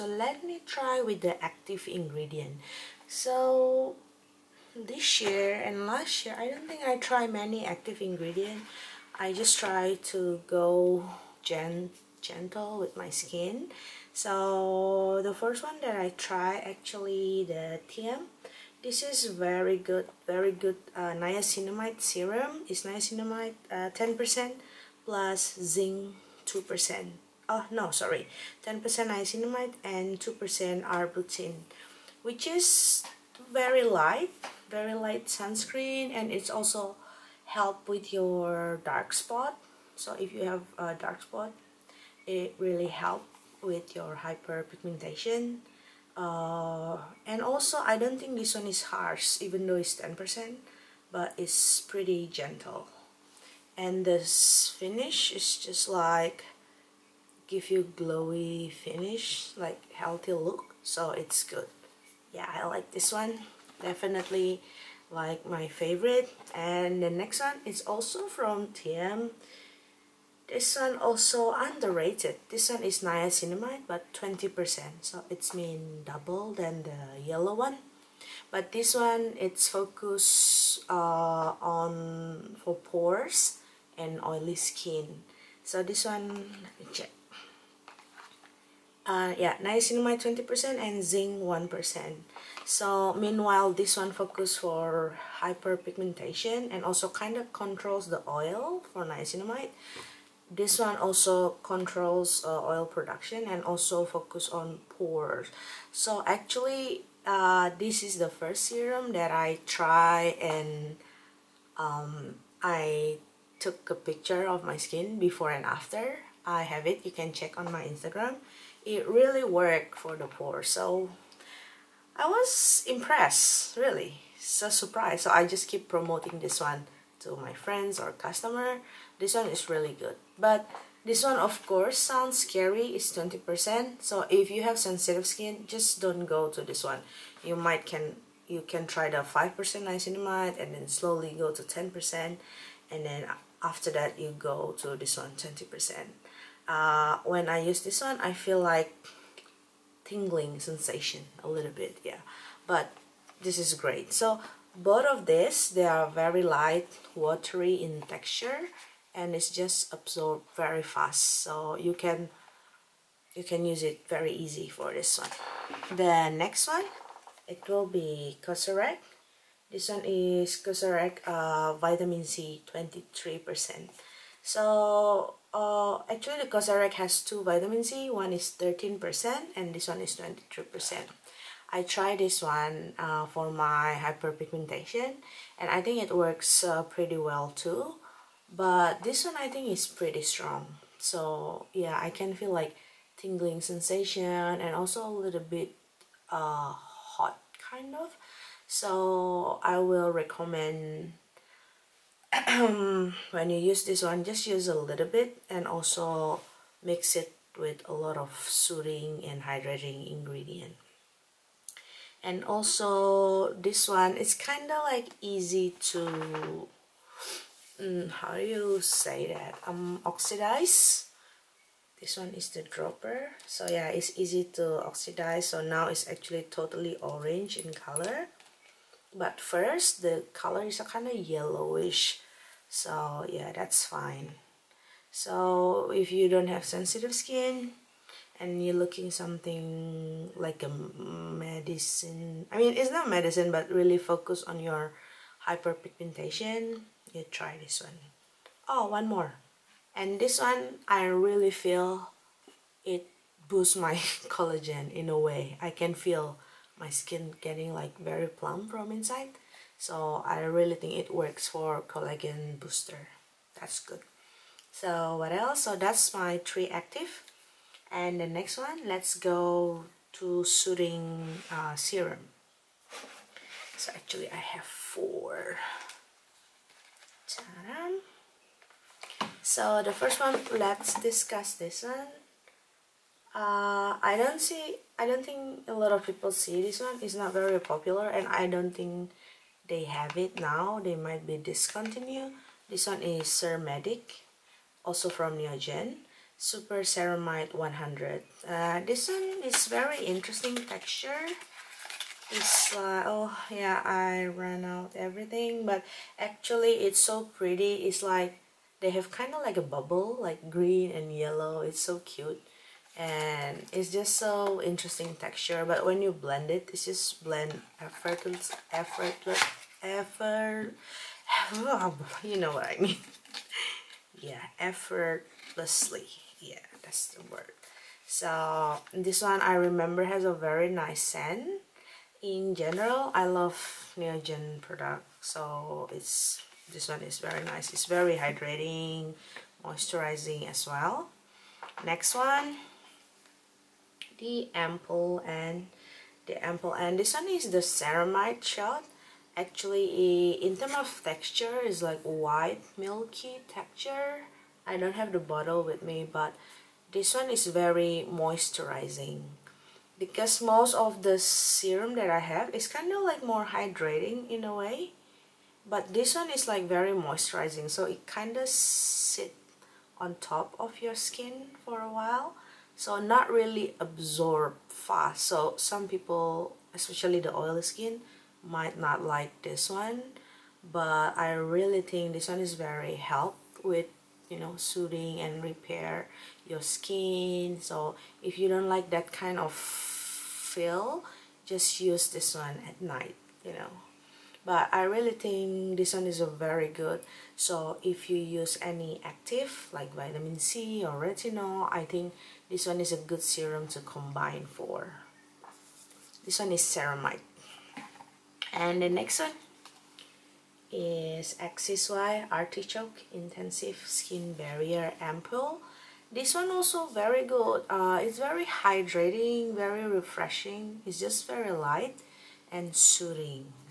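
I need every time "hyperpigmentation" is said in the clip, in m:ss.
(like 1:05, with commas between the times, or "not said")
0:44, 1:35, 3:03, 4:05.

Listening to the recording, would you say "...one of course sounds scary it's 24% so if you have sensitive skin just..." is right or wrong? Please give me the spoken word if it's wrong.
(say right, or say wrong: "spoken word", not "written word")
wrong: "20", not "24".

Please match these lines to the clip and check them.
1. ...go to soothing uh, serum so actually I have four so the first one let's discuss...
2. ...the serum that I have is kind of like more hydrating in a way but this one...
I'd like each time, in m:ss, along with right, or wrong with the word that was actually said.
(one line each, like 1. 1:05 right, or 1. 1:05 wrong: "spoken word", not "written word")
1. 4:29 right
2. 6:01 right.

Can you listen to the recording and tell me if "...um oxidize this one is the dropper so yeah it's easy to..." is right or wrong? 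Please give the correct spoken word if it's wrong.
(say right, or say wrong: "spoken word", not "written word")
right.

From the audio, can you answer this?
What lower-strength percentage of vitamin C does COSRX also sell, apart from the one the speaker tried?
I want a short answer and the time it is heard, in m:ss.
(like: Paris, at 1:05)
13%, at 2:58.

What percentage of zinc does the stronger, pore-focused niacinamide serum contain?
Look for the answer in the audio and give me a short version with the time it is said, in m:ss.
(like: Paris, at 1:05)
1%, at 1:31.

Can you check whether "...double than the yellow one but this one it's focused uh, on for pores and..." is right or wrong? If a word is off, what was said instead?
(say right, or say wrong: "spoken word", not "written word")
right.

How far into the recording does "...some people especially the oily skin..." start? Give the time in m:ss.
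6:15.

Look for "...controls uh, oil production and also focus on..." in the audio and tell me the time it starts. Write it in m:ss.
1:41.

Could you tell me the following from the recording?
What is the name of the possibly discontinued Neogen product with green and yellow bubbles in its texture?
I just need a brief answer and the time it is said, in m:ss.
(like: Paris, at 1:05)
Super Ceramide 100, at 4:56.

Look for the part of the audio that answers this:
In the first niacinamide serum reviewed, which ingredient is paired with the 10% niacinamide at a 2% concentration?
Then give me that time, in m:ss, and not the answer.
0:30.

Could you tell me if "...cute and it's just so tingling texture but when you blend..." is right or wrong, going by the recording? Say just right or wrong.
wrong.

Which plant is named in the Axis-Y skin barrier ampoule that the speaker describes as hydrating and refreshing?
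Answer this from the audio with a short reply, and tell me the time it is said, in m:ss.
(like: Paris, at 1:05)
Artichoke, at 6:52.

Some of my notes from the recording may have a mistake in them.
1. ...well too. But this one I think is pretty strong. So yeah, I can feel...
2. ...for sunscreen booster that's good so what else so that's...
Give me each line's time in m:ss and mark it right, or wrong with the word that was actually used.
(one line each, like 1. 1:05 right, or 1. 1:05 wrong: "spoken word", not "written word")
1. 3:07 right
2. 4:21 wrong: "collagen", not "sunscreen".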